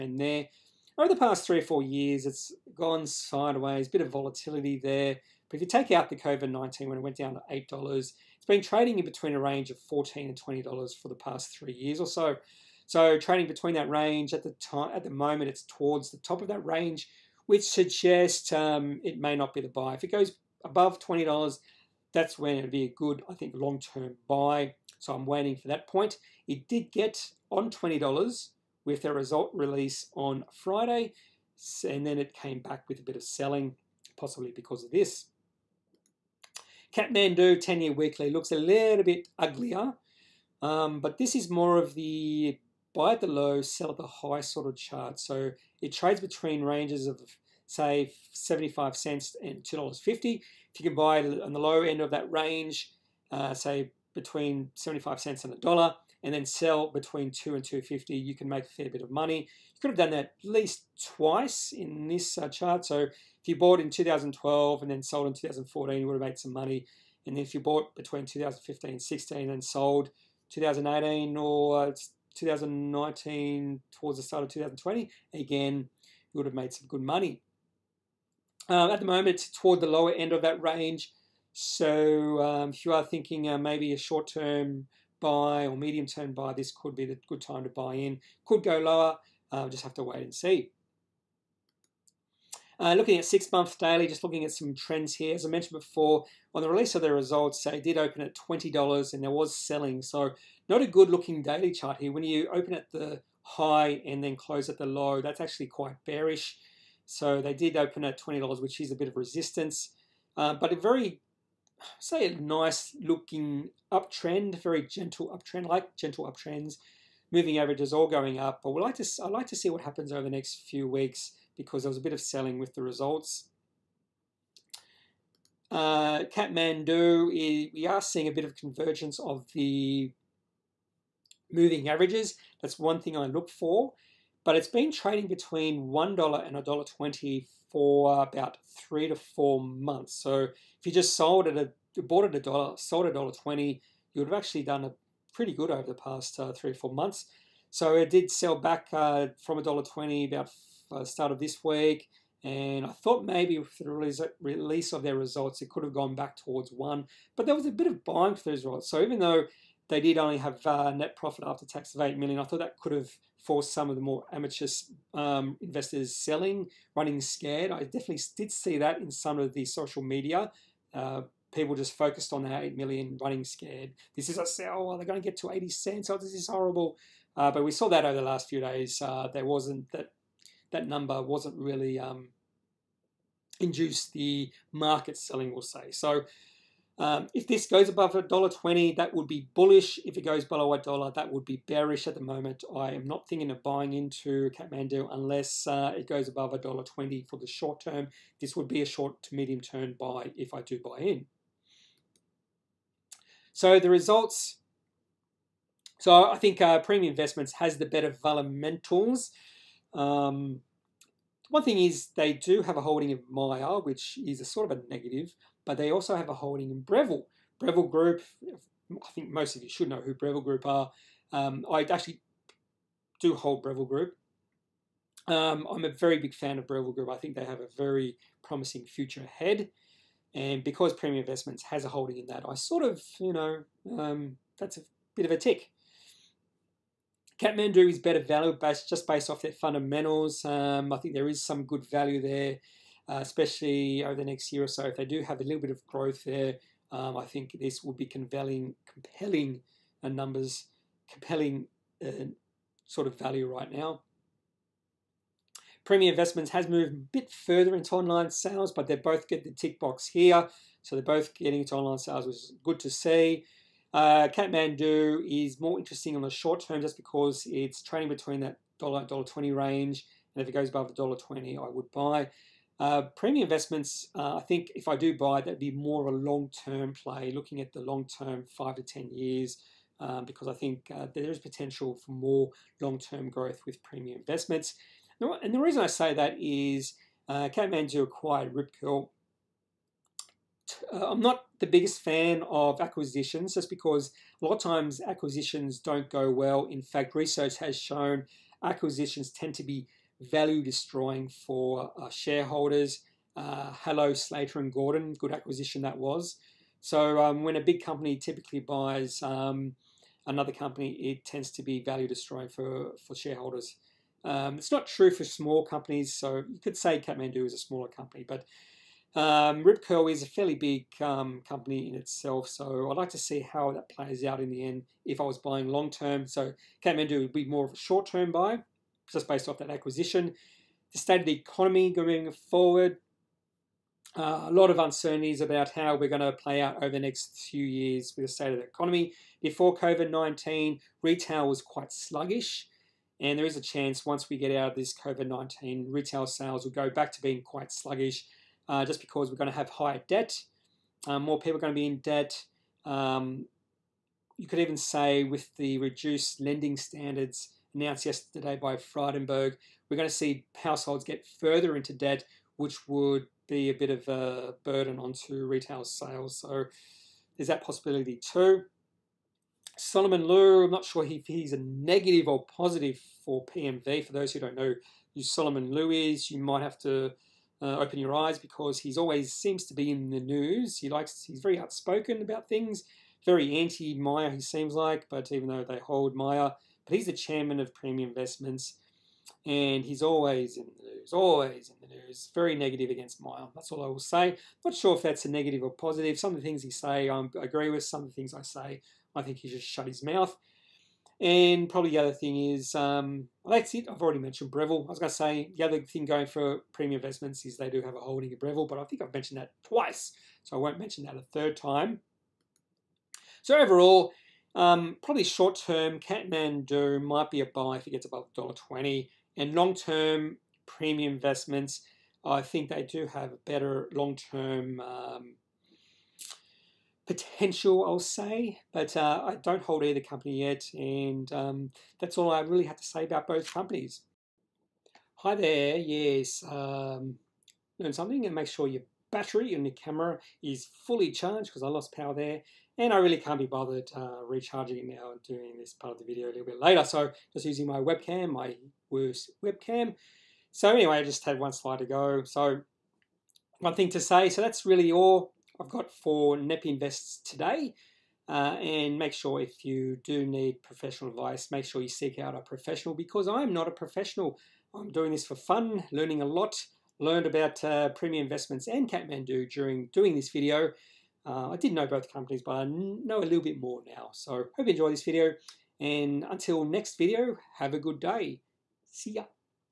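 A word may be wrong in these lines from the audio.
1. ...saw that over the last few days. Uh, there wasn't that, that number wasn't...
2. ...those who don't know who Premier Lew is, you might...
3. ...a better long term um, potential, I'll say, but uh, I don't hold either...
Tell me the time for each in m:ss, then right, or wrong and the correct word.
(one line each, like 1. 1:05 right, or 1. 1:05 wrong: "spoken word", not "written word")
1. 2:57 right
2. 6:14 wrong: "Solomon", not "Premier"
3. 7:03 right.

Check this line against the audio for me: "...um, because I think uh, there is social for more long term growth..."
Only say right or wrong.
wrong.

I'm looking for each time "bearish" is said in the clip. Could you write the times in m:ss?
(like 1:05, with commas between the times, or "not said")
1:46, 3:11.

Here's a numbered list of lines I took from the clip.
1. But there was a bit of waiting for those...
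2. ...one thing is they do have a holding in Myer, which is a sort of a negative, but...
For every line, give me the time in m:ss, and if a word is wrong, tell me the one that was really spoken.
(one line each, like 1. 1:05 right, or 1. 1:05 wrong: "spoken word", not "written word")
1. 2:37 wrong: "buying", not "waiting"
2. 3:31 right.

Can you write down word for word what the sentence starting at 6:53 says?
So overall, um, probably short term, Kathmandu might be a buy if it gets above twenty.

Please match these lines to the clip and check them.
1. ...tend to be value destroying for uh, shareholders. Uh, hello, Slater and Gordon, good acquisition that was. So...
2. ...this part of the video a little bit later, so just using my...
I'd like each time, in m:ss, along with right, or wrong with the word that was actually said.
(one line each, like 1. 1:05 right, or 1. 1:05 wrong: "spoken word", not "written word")
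1. 4:59 right
2. 7:25 right.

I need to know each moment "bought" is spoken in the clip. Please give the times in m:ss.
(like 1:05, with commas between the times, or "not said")
1:03, 1:07, 2:22.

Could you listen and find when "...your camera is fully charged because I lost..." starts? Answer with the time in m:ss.
7:19.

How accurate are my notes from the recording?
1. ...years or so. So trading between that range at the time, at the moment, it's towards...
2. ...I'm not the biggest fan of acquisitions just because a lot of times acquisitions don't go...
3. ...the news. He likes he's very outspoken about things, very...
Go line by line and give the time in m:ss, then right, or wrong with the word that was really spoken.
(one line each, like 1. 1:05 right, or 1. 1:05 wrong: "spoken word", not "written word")
1. 0:11 right
2. 4:51 right
3. 6:20 right.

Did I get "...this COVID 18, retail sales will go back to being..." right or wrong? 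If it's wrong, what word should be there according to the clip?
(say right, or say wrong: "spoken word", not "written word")
wrong: "19", not "18".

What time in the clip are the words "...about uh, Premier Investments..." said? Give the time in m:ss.
7:47.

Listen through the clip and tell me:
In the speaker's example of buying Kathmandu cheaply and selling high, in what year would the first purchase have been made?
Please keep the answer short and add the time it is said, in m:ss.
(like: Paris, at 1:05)
2012, at 1:03.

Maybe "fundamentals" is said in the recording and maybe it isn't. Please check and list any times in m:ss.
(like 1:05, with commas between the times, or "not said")
3:28, 3:59.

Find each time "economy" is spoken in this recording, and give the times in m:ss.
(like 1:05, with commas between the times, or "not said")
5:31, 5:38.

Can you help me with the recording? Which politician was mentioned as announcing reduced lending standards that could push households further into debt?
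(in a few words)
Frydenberg.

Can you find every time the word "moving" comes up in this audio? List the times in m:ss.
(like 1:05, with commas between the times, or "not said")
1:57, 2:11.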